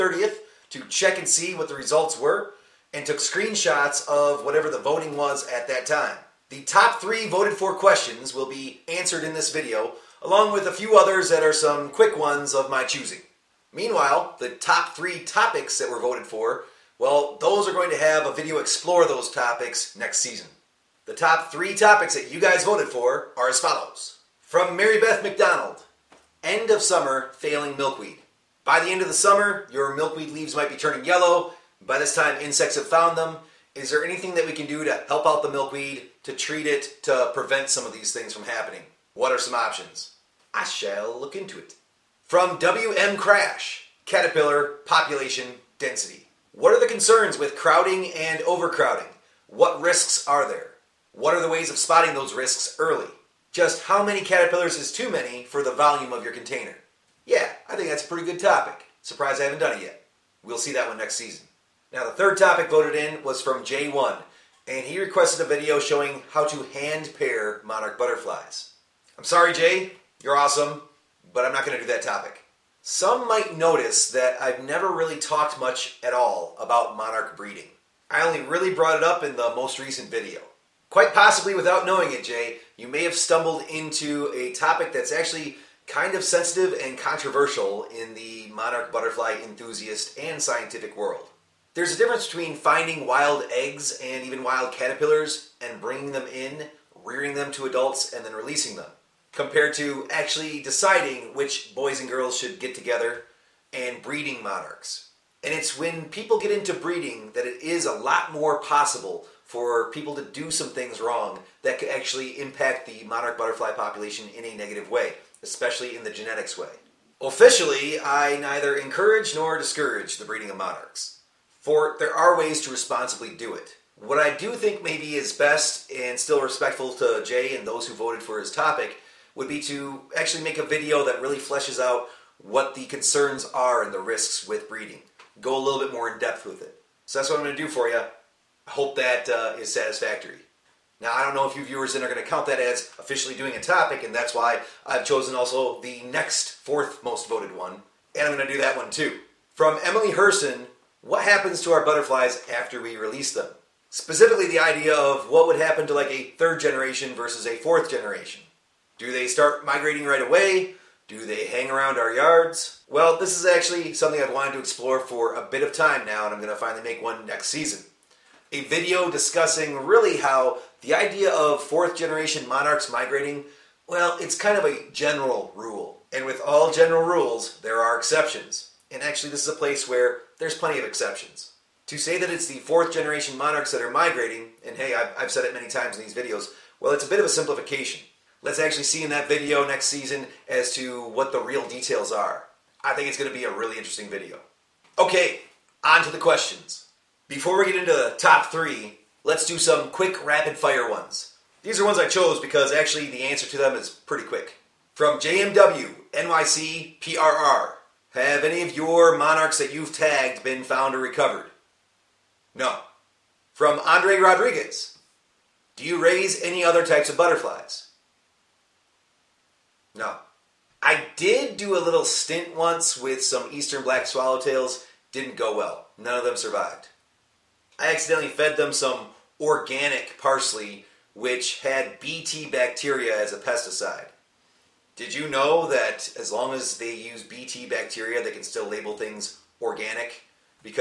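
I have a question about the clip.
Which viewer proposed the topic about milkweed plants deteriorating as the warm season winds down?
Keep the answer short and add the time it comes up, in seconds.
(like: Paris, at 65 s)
Mary Beth McDonald, at 24 s.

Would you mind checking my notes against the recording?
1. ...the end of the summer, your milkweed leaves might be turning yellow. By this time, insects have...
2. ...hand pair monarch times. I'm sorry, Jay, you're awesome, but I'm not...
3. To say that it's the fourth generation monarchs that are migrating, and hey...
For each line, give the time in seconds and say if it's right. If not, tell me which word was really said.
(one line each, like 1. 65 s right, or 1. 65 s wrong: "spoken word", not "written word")
1. 28 s right
2. 66 s wrong: "butterflies", not "times"
3. 181 s right.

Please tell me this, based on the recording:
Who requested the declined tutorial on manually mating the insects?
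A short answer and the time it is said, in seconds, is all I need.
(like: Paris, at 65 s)
J1, at 63 s.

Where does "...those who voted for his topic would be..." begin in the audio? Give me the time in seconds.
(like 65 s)
127 s.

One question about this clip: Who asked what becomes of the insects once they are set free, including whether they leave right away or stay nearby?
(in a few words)
Emily Herson.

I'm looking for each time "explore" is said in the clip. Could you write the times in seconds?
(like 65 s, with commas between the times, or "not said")
18 s, 164 s.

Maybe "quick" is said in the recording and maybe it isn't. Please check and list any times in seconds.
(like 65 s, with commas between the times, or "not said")
11 s, 199 s, 204 s.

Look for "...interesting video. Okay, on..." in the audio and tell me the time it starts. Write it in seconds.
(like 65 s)
193 s.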